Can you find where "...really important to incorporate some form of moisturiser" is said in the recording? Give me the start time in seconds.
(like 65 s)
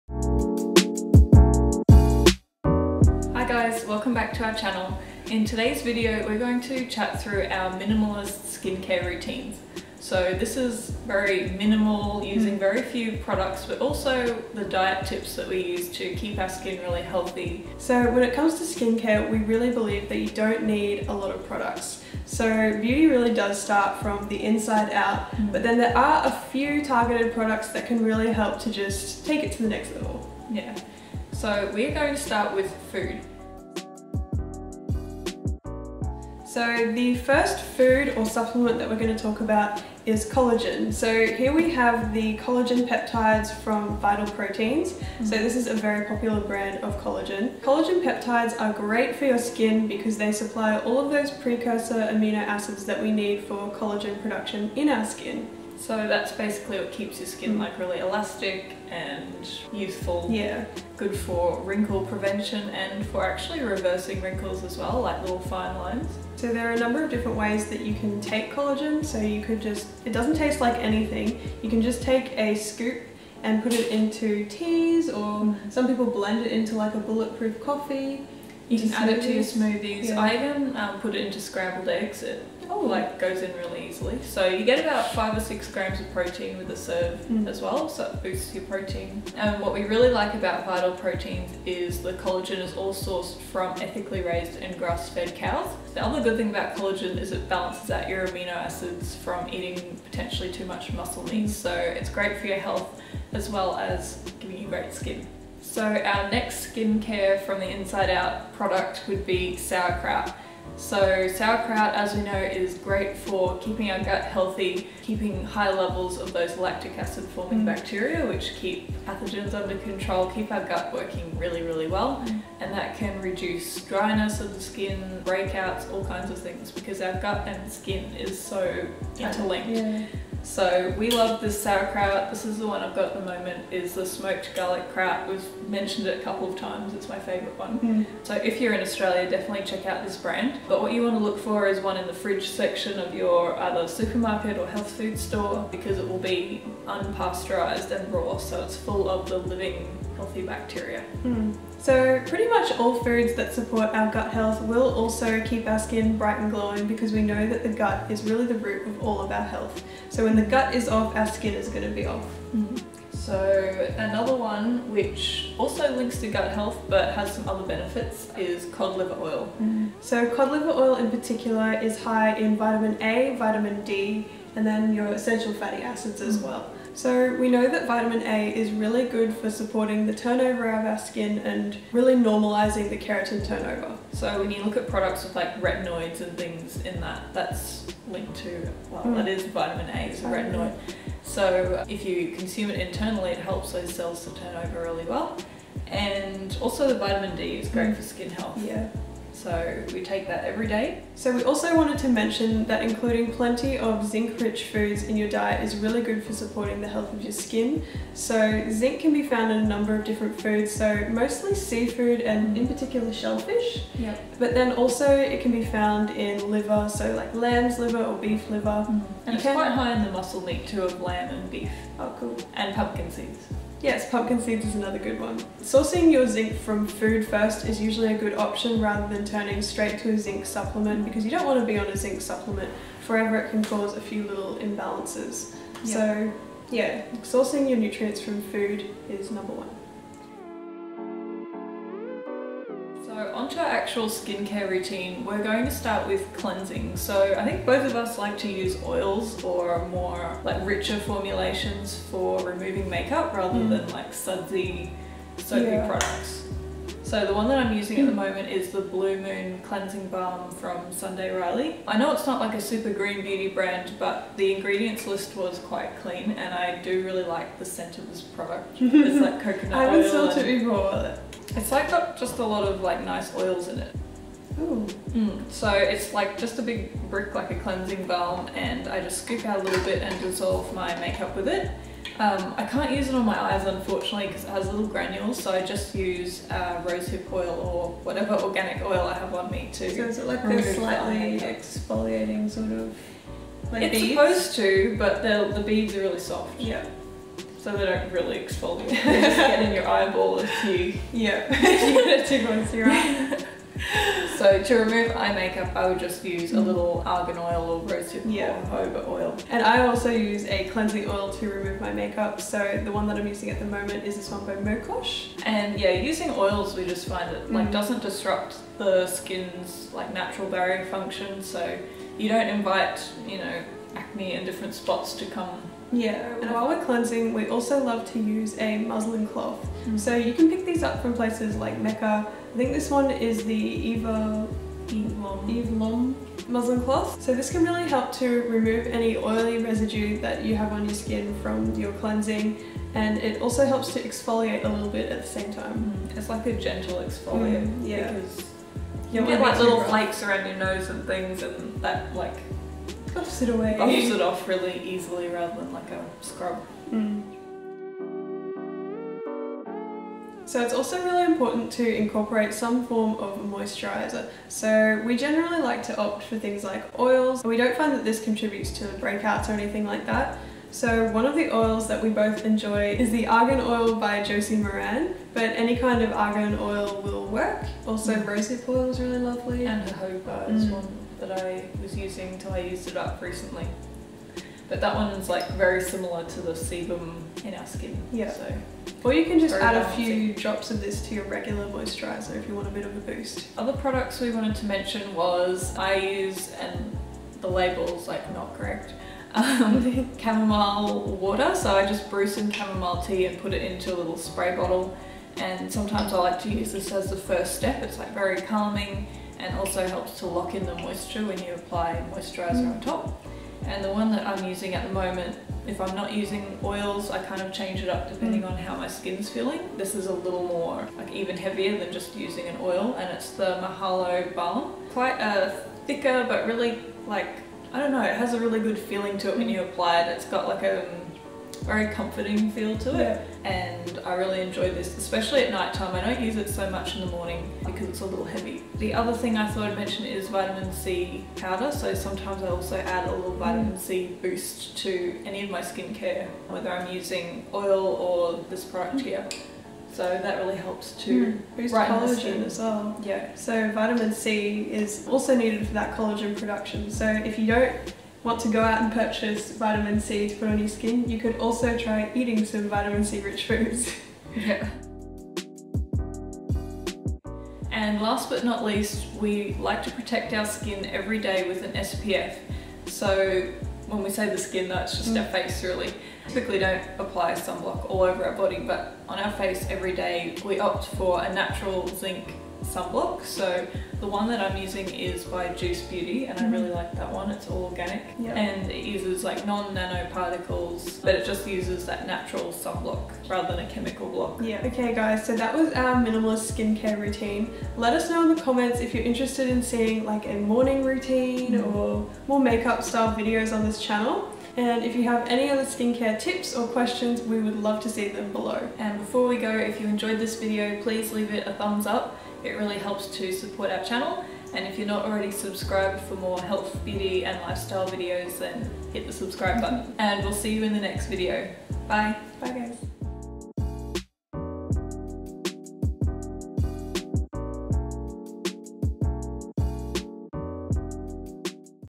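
361 s.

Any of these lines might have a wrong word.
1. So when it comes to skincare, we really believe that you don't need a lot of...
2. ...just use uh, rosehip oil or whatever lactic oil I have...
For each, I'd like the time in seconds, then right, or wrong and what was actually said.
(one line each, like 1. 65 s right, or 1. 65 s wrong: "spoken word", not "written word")
1. 17 s right
2. 285 s wrong: "organic", not "lactic".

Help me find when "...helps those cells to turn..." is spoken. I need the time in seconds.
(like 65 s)
193 s.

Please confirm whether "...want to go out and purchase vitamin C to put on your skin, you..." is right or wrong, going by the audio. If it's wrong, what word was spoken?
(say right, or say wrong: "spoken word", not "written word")
right.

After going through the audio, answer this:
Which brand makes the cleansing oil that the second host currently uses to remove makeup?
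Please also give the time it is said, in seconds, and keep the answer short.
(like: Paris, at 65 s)
Mokosh, at 314 s.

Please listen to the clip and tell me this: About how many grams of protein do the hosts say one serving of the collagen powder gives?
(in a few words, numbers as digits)
5 or 6 grams.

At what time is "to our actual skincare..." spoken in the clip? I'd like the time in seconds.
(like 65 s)
243 s.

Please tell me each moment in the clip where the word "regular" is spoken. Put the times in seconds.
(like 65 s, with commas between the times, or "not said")
391 s.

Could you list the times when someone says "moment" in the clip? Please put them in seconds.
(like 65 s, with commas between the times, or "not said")
133 s, 258 s, 313 s, 414 s.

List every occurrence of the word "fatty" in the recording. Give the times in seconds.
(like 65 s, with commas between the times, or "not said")
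175 s.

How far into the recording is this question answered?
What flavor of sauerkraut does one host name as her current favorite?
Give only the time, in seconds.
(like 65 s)
134 s.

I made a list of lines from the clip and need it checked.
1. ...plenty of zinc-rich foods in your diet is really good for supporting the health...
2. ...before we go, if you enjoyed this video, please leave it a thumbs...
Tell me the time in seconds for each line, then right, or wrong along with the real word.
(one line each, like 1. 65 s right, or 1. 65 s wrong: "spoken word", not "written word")
1. 203 s right
2. 508 s right.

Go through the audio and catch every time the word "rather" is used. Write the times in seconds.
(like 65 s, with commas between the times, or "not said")
228 s, 253 s, 355 s, 493 s.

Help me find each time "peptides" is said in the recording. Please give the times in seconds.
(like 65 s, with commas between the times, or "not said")
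42 s, 48 s.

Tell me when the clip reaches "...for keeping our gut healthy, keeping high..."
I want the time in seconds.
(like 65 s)
113 s.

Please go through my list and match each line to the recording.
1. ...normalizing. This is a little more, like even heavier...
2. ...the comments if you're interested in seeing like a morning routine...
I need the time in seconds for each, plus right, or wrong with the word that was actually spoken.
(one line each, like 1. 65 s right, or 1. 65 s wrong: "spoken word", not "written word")
1. 419 s wrong: "feeling", not "normalizing"
2. 498 s right.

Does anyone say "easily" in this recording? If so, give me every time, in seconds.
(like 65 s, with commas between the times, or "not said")
83 s, 354 s.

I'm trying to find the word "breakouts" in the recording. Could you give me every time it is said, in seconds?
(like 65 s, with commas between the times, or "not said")
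125 s, 368 s.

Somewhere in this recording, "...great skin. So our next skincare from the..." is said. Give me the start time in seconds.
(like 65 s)
104 s.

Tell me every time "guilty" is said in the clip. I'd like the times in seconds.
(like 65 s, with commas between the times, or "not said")
not said.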